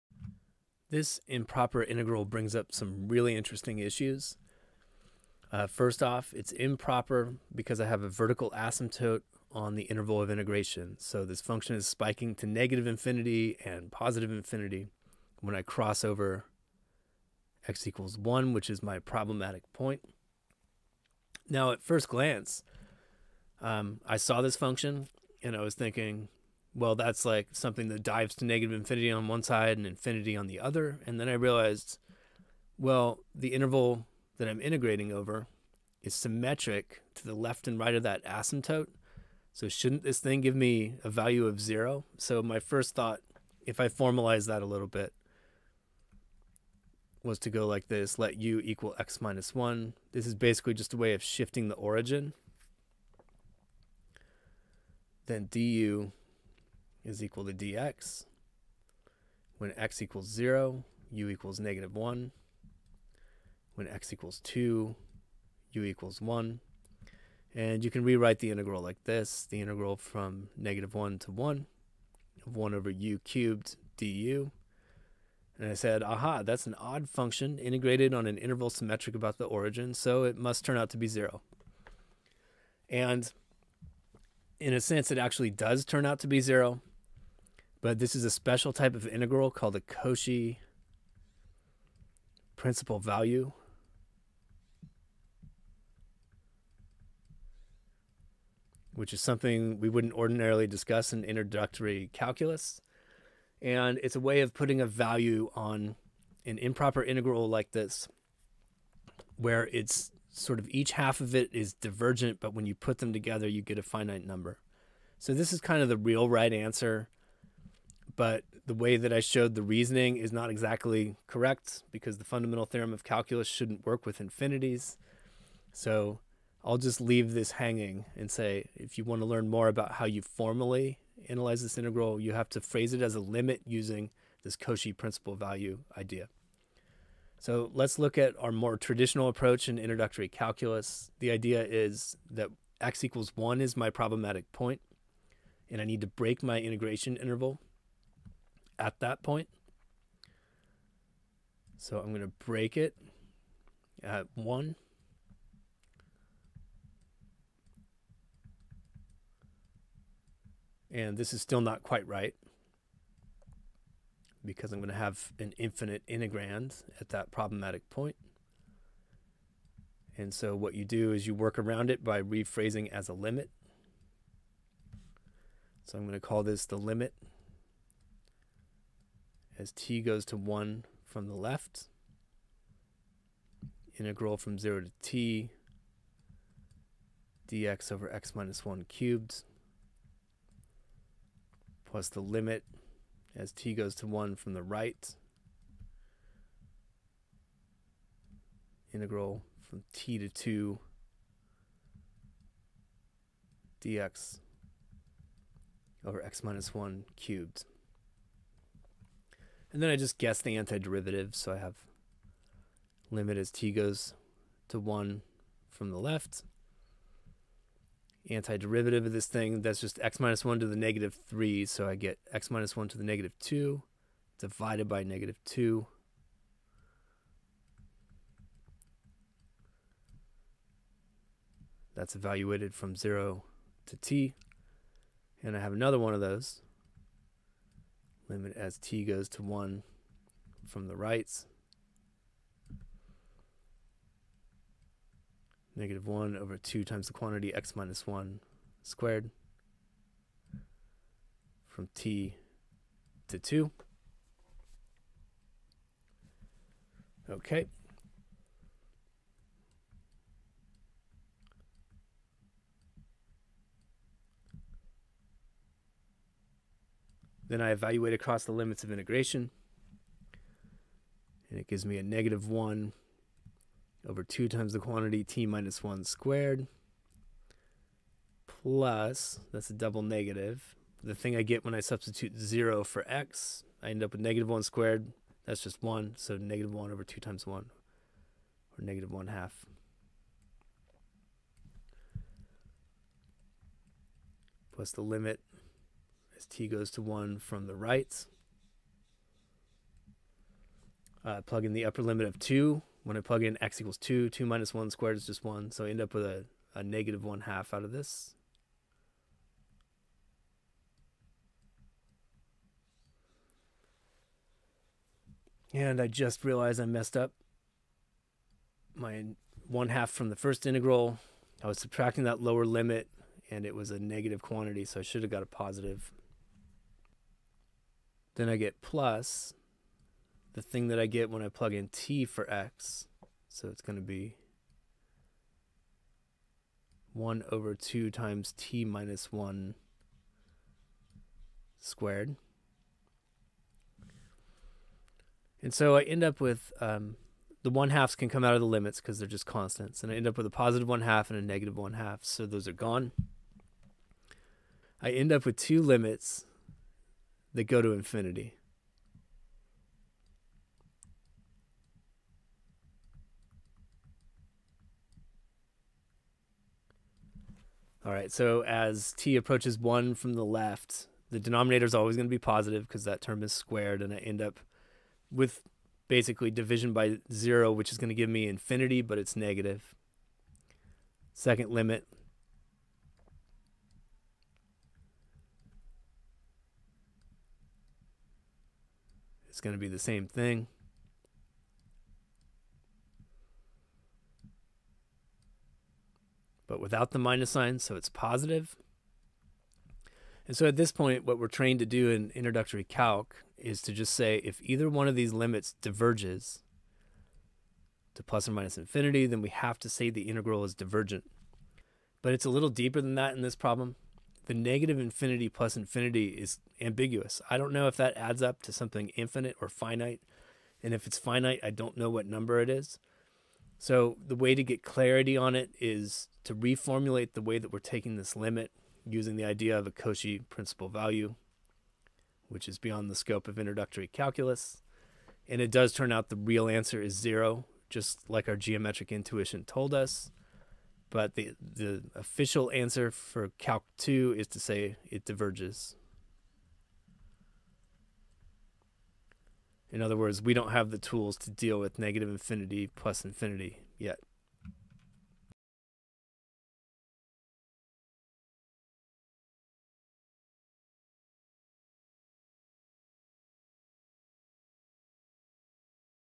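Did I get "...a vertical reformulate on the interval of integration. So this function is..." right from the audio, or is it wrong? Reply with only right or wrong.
wrong.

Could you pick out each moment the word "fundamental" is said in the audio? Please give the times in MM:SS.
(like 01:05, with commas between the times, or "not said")
02:02.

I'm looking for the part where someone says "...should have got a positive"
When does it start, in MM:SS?
05:25.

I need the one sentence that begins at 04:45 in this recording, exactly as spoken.
That's just 1, so negative 1 over 2 times 1, or negative 1 half.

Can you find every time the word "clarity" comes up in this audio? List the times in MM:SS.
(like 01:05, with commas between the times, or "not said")
07:04.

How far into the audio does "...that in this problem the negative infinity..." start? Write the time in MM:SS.
06:53.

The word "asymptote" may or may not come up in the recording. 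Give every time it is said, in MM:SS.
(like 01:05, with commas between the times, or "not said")
00:08, 00:38.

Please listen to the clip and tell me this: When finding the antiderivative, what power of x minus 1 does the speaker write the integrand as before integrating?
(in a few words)
-3.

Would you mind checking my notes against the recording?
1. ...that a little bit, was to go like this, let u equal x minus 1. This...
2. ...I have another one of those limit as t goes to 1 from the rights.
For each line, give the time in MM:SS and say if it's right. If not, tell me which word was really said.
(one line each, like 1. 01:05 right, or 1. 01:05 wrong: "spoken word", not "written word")
1. 00:44 right
2. 03:55 right.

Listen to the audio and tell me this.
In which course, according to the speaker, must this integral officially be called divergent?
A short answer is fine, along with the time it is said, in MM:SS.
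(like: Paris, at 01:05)
Calc 2, at 07:23.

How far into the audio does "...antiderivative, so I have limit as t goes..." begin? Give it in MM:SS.
03:30.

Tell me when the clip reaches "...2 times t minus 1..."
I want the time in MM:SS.
05:37.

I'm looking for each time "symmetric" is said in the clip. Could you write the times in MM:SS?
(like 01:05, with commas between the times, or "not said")
00:36, 01:18.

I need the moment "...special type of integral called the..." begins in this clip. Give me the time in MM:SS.
01:28.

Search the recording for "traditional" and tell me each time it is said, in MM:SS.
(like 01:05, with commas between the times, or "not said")
02:18.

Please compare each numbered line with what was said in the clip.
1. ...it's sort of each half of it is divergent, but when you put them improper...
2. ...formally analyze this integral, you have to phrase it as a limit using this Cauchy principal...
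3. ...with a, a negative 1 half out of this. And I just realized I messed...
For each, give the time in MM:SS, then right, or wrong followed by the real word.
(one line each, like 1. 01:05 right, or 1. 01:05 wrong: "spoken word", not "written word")
1. 01:49 wrong: "together", not "improper"
2. 02:10 right
3. 05:06 right.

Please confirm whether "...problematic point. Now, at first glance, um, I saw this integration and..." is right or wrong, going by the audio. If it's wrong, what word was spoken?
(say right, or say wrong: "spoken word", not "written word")
wrong: "function", not "integration".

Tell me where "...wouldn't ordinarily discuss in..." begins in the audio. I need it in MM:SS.
01:39.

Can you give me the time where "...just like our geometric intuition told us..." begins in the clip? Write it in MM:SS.
07:17.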